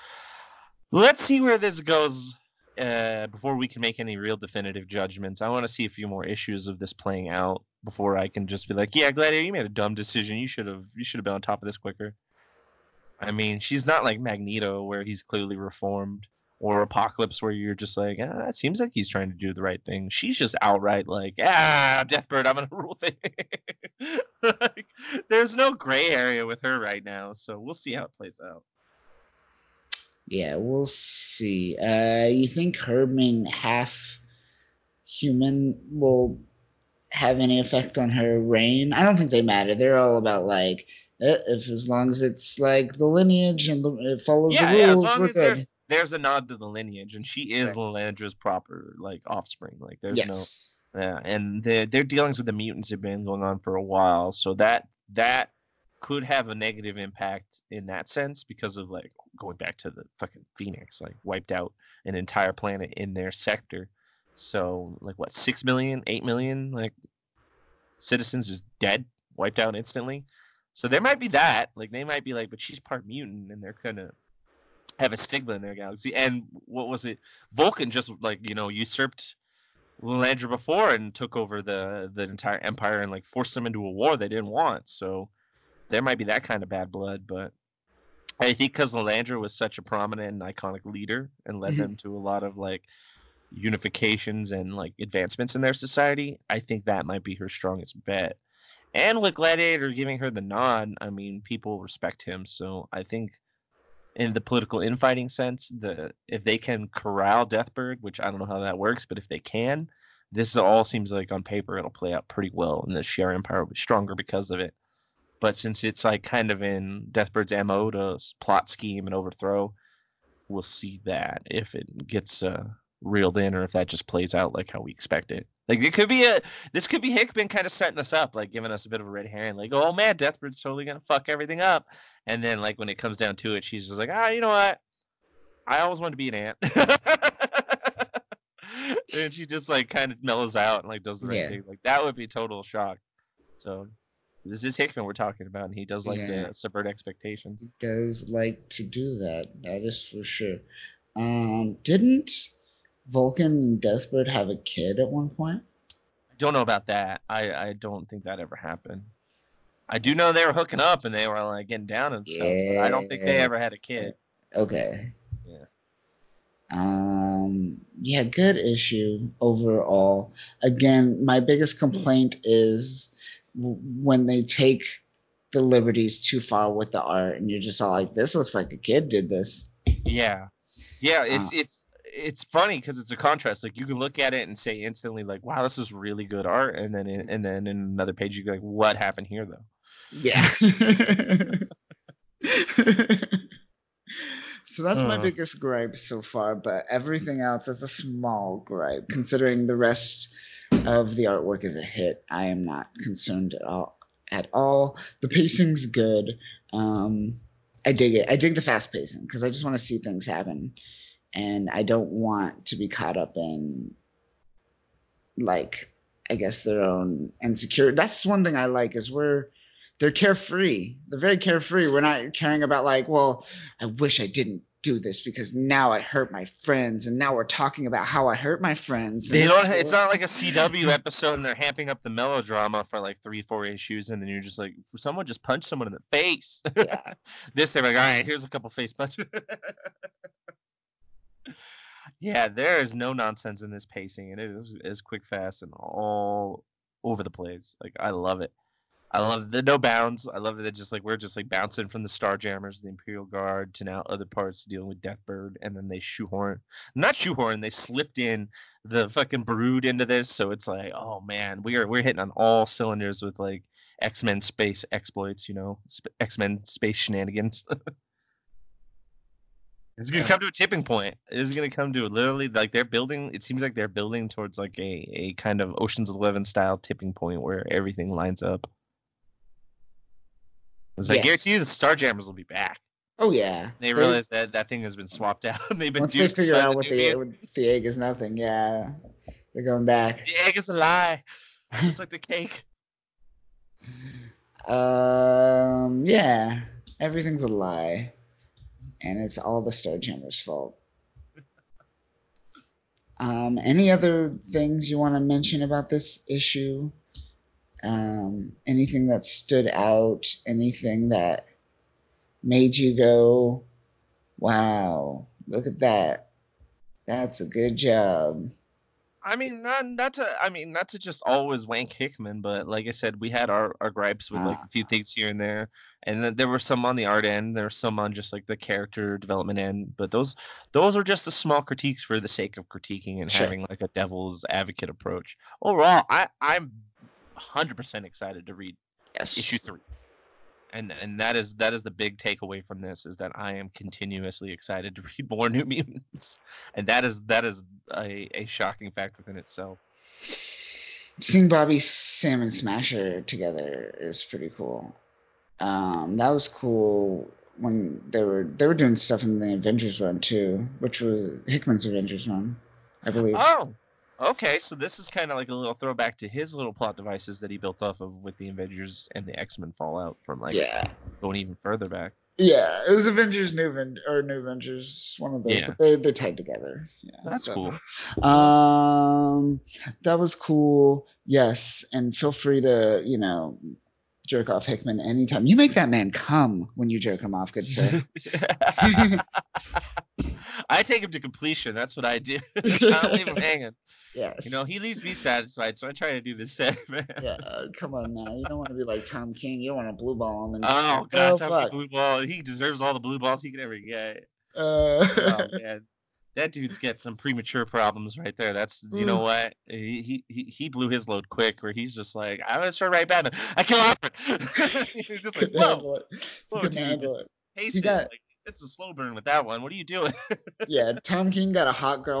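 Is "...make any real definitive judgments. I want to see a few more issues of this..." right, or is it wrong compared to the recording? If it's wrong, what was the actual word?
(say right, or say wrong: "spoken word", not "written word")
right.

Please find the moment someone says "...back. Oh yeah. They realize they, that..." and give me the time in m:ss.
4:42.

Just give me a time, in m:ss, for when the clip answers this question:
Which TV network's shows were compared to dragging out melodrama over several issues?
3:50.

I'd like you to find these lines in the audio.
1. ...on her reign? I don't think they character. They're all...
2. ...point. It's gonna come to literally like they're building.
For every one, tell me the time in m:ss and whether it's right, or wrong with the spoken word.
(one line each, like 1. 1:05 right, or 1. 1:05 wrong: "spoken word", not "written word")
1. 0:37 wrong: "matter", not "character"
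2. 4:30 right.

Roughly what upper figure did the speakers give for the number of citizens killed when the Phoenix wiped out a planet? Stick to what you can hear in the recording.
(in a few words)
8 million.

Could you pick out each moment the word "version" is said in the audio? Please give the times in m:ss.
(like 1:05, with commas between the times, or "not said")
not said.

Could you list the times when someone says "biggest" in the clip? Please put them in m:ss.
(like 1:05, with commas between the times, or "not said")
2:51, 3:15.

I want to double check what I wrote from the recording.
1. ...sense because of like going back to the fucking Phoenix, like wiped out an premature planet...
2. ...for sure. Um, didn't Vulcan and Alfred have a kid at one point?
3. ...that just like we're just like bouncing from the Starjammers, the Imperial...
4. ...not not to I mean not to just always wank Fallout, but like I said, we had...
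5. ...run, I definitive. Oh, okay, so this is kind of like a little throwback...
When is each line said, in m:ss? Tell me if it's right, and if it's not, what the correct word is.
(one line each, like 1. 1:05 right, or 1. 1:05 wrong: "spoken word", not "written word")
1. 0:58 wrong: "entire", not "premature"
2. 2:30 wrong: "Deathbird", not "Alfred"
3. 4:10 right
4. 5:19 wrong: "Hickman", not "Fallout"
5. 6:02 wrong: "believe", not "definitive".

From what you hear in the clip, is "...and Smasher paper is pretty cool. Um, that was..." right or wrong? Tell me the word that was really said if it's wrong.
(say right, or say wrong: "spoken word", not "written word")
wrong: "together", not "paper".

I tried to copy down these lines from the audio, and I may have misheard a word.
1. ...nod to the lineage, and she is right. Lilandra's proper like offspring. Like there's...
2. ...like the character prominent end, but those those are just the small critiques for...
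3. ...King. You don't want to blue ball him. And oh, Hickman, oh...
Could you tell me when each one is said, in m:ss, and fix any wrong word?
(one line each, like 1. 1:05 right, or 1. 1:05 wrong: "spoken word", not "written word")
1. 0:46 right
2. 5:28 wrong: "development", not "prominent"
3. 6:39 wrong: "God", not "Hickman".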